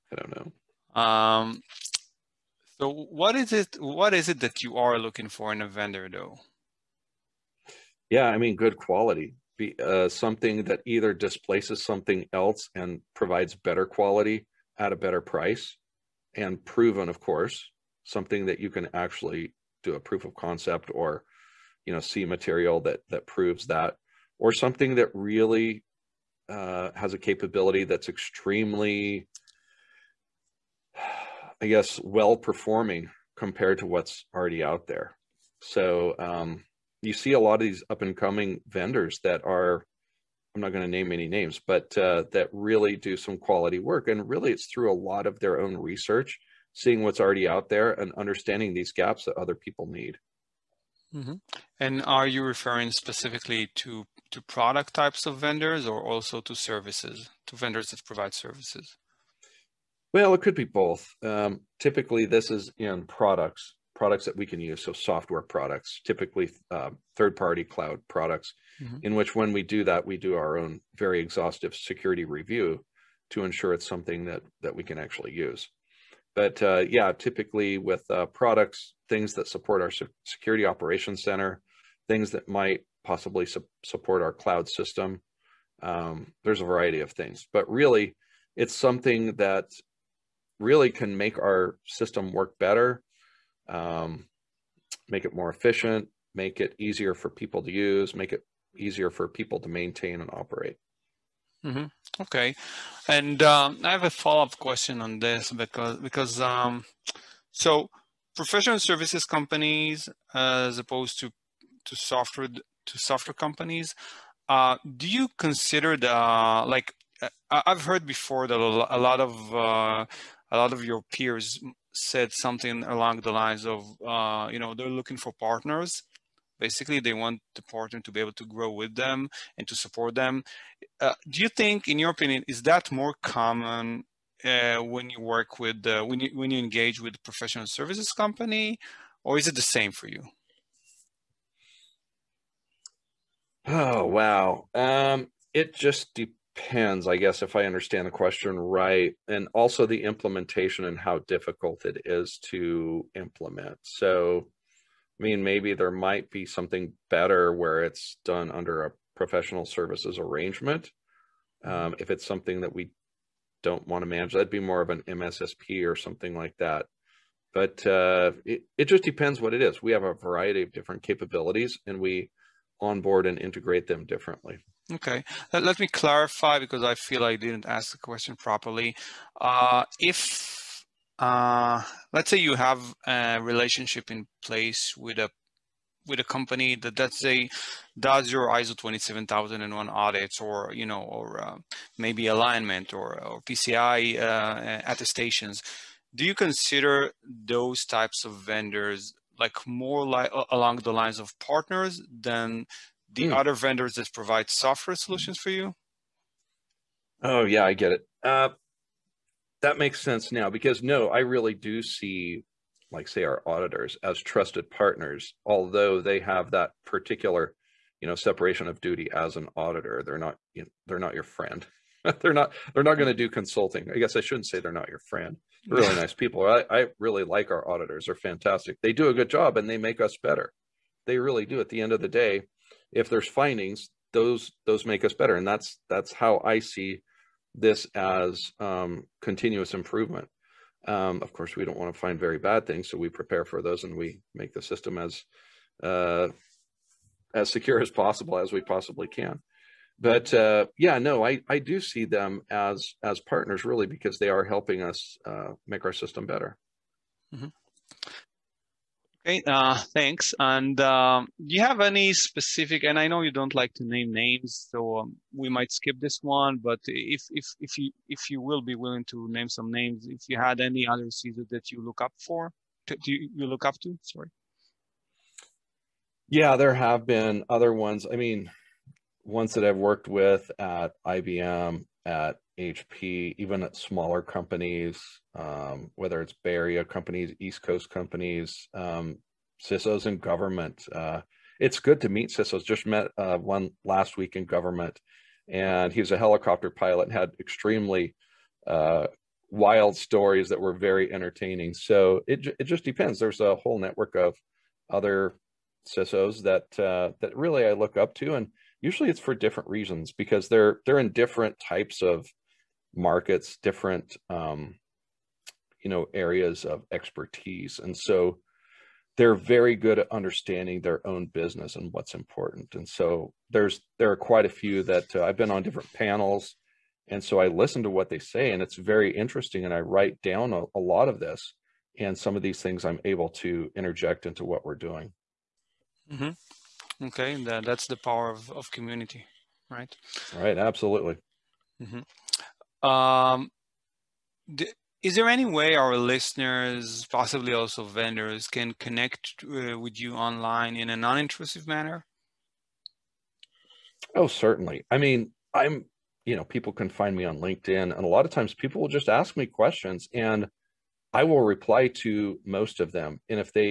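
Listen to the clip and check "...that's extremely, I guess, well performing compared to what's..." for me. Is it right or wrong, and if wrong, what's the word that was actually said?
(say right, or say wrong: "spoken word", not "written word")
right.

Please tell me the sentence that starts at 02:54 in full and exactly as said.
Okay, let, me clarify because I feel I didn't ask the question properly.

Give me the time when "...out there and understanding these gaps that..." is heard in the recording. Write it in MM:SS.
00:47.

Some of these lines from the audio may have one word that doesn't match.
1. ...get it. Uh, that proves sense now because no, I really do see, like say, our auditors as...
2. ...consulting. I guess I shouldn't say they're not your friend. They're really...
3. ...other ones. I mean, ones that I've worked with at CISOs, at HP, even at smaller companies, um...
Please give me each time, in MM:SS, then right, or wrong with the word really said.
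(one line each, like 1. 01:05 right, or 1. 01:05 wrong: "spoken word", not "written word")
1. 03:27 wrong: "makes", not "proves"
2. 03:43 right
3. 04:37 wrong: "IBM", not "CISOs".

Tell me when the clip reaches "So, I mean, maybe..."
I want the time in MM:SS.
02:33.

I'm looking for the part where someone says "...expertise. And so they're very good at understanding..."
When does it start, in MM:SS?
05:16.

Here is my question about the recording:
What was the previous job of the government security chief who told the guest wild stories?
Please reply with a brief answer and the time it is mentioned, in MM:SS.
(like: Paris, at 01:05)
helicopter pilot, at 04:56.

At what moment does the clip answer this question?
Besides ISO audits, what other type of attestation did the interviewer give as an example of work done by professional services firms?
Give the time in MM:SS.
03:13.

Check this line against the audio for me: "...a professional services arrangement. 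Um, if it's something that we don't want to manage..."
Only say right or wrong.
right.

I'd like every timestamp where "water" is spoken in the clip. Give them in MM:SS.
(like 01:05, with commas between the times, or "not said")
not said.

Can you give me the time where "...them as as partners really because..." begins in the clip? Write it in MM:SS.
04:12.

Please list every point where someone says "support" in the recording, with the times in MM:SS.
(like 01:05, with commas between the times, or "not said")
01:19, 01:23, 02:09.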